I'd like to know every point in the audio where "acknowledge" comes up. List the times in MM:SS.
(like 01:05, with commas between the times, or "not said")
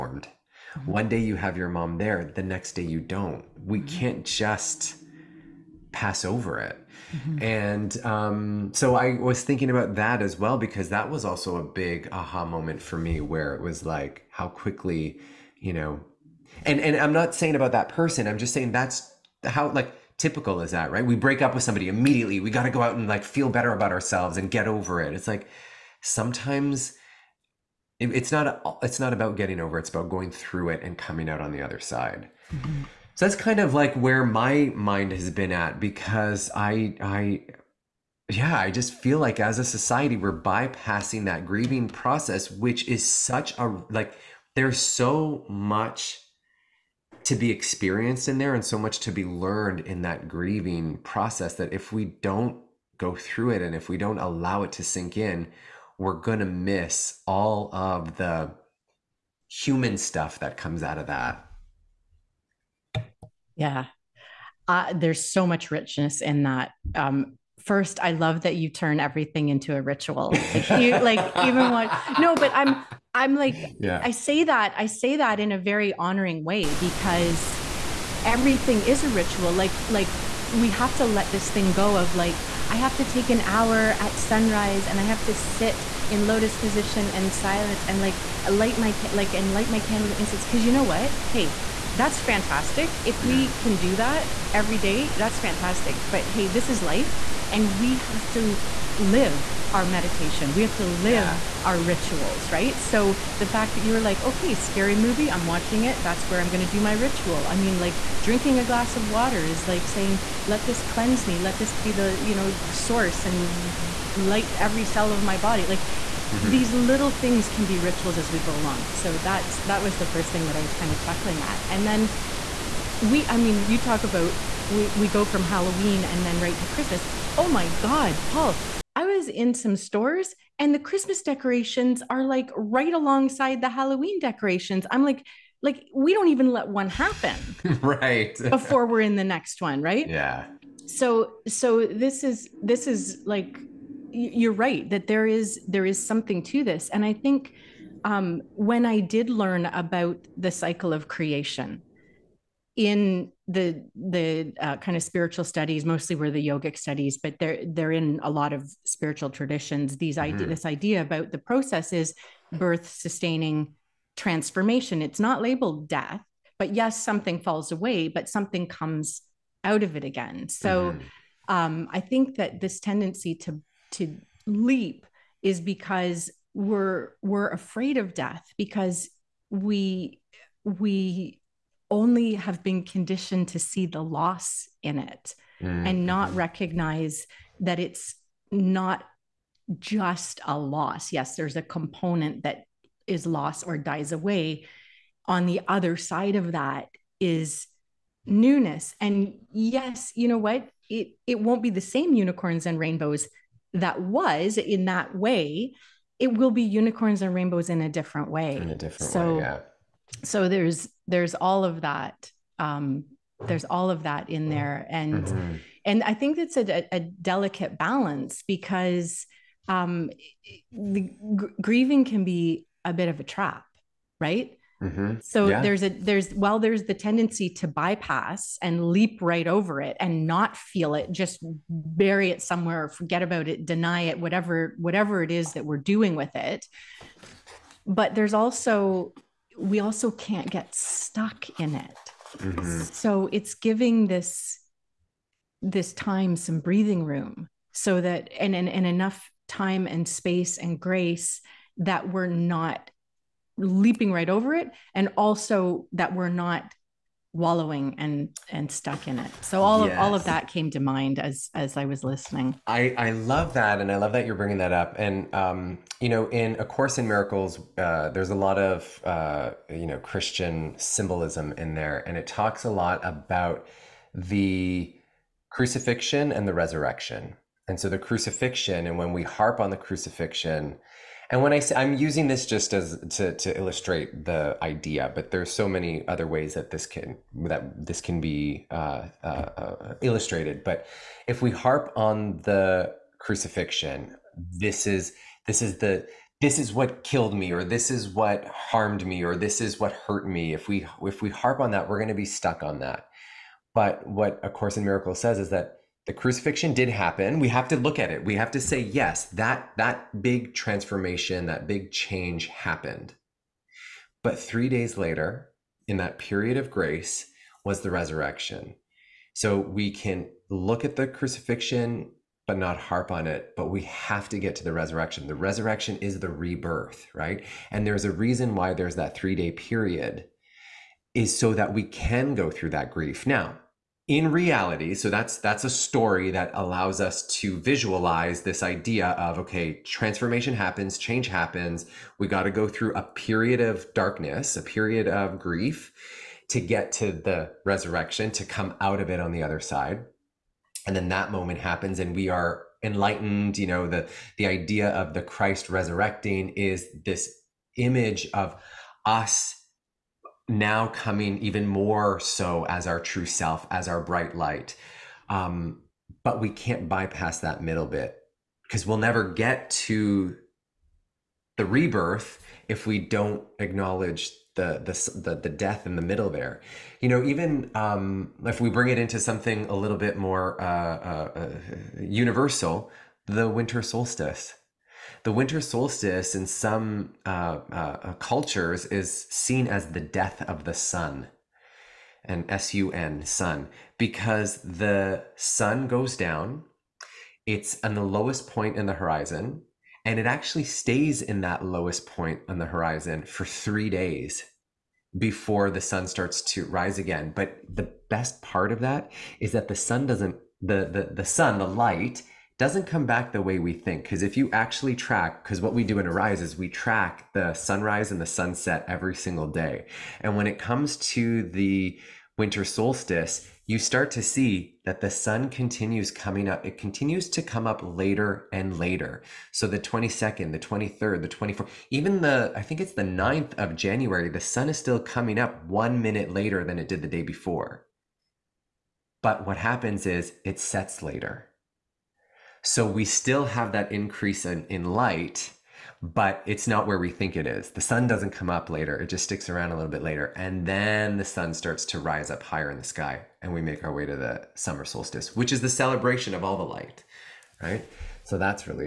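06:13.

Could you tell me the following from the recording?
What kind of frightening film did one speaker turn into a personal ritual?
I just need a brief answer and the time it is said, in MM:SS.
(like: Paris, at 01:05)
Scary movie, at 01:44.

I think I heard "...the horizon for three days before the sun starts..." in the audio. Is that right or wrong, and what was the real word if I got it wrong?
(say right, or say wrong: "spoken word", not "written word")
right.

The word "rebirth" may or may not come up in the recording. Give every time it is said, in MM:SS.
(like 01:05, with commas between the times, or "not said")
05:26, 06:11.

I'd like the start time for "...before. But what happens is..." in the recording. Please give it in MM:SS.
07:17.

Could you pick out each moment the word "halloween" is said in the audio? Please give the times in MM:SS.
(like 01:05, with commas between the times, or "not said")
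02:05, 02:13.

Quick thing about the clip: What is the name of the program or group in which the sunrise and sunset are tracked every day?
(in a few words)
Arise.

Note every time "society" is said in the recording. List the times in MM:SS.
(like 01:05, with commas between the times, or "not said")
00:39.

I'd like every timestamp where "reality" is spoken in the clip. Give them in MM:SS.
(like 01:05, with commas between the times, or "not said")
05:34.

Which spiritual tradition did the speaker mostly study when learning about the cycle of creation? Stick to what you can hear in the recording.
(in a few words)
Yogic studies.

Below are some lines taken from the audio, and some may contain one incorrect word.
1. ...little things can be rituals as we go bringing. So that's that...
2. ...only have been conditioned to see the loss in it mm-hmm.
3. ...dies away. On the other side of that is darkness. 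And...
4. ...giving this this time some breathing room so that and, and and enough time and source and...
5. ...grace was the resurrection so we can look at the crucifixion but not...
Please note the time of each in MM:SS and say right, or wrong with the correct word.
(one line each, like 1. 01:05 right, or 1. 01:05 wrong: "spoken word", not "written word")
1. 01:56 wrong: "along", not "bringing"
2. 03:01 right
3. 03:13 wrong: "newness", not "darkness"
4. 04:03 wrong: "space", not "source"
5. 05:16 right.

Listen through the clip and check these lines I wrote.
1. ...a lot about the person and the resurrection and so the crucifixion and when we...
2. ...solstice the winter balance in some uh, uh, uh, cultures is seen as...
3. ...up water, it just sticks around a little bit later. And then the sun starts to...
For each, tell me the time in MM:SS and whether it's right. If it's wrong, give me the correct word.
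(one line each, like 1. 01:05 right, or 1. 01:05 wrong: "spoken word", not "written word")
1. 04:32 wrong: "crucifixion", not "person"
2. 06:23 wrong: "solstice", not "balance"
3. 07:28 wrong: "later", not "water".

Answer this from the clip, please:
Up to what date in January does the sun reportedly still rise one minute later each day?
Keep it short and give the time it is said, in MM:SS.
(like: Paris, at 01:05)
January 9, at 07:13.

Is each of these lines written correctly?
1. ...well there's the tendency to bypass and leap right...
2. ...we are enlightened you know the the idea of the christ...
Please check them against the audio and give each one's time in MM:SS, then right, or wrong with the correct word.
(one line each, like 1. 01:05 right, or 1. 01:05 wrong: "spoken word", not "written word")
1. 03:46 right
2. 05:52 right.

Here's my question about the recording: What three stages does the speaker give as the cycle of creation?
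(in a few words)
Birth, sustaining, transformation.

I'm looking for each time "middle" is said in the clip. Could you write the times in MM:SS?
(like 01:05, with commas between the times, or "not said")
06:07, 06:16.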